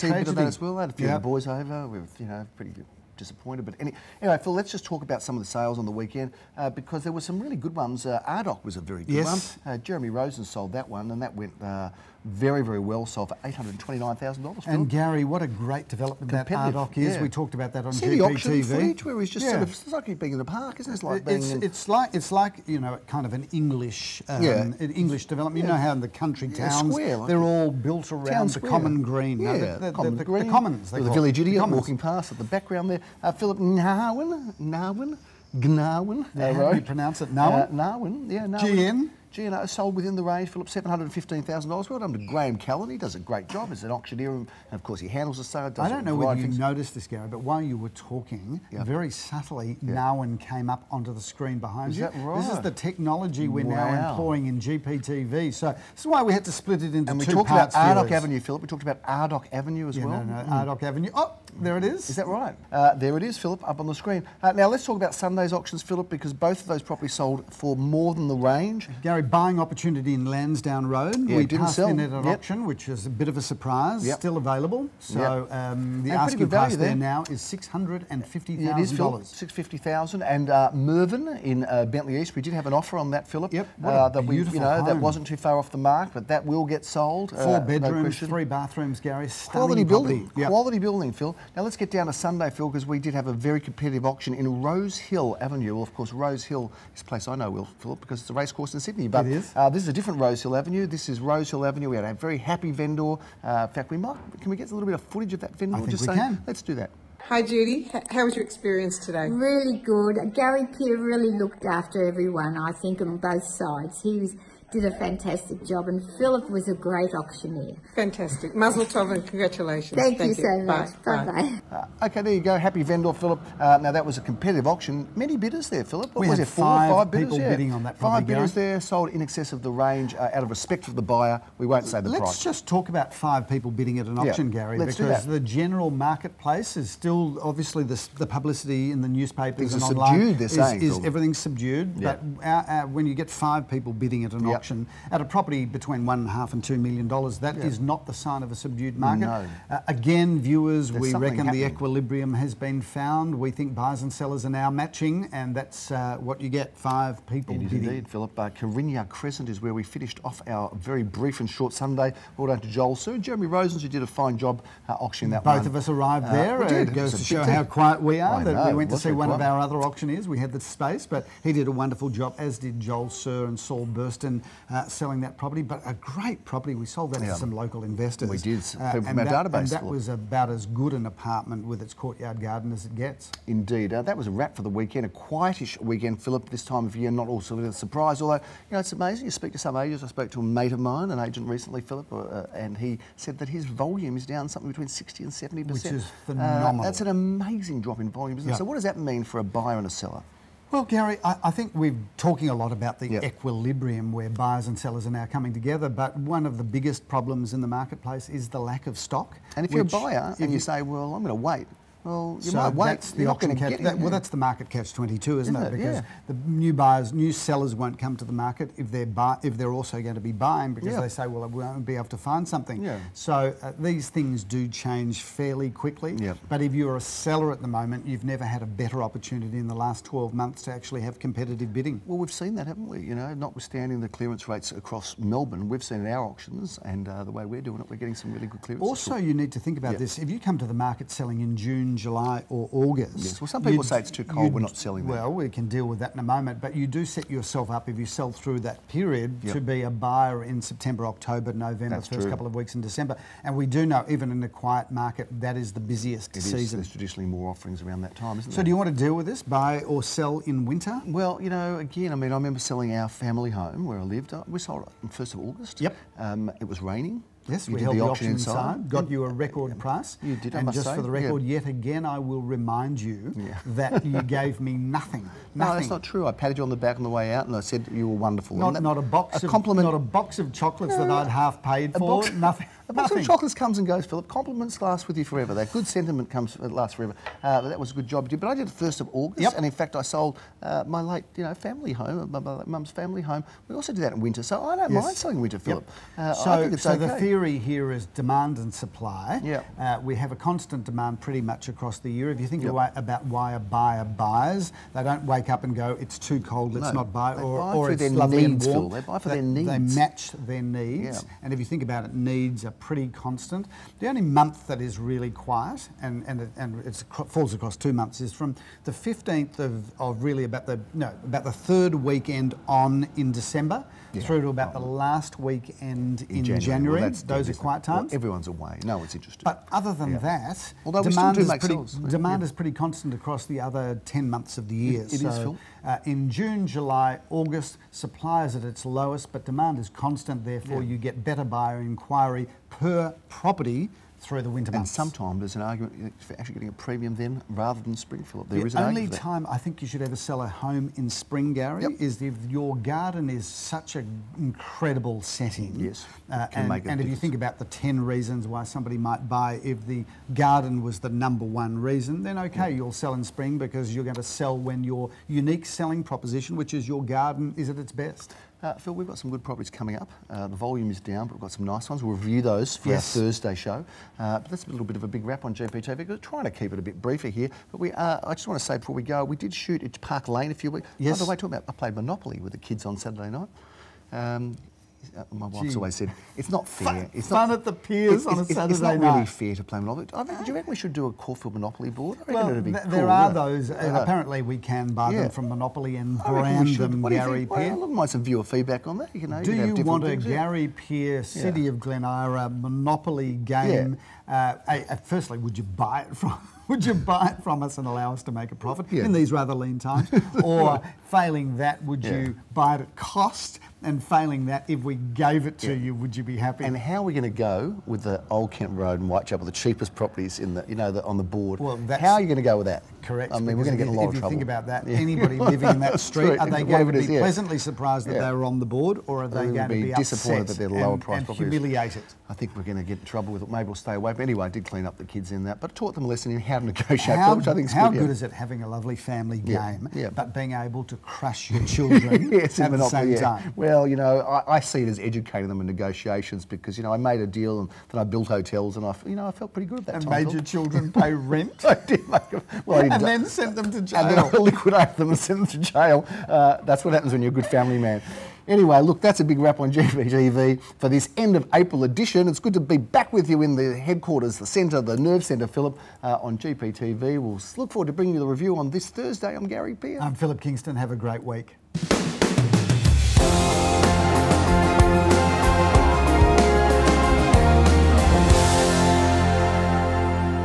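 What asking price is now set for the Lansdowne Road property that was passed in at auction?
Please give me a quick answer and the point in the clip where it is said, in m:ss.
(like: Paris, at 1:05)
$650,000, at 1:17.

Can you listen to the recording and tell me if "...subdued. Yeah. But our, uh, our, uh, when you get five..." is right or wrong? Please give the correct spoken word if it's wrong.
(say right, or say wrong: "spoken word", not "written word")
right.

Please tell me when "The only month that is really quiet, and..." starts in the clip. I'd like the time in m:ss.
5:13.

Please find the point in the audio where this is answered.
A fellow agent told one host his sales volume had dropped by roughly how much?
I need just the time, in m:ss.
3:14.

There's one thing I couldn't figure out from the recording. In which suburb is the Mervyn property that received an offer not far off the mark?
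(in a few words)
Bentleigh East.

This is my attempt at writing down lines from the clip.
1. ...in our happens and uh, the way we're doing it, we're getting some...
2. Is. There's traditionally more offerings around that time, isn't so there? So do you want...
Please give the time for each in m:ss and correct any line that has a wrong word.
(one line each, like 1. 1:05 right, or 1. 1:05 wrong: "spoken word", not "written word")
1. 3:56 wrong: "auctions", not "happens"
2. 4:16 right.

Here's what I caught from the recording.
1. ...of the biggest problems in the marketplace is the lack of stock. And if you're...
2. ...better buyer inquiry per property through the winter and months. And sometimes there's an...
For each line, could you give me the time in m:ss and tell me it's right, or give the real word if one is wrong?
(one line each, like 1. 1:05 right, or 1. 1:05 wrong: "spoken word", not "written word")
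1. 3:26 right
2. 5:41 right.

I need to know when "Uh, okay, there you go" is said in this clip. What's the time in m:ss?
2:02.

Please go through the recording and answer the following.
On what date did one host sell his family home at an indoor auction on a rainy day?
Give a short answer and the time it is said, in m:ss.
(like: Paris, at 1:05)
1st of August, at 4:25.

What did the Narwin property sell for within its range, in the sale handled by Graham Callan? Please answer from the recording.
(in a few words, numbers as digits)
$715,000.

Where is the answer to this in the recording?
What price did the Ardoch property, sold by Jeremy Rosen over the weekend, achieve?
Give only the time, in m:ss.
0:13.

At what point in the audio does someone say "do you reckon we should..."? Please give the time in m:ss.
6:30.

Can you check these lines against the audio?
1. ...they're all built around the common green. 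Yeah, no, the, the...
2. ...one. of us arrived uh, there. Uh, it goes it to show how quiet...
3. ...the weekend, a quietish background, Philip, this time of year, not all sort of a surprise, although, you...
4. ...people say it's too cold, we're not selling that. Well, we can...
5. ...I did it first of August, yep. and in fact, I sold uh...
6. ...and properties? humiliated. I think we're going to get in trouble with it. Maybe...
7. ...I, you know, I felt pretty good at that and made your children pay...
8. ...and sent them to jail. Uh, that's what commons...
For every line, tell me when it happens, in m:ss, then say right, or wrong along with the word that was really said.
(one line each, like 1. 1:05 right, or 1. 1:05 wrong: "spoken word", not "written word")
1. 0:27 right
2. 2:45 right
3. 3:04 wrong: "weekend", not "background"
4. 4:03 right
5. 4:48 right
6. 7:11 right
7. 7:28 right
8. 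7:35 wrong: "happens", not "commons".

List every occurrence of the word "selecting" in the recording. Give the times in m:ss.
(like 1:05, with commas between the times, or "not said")
not said.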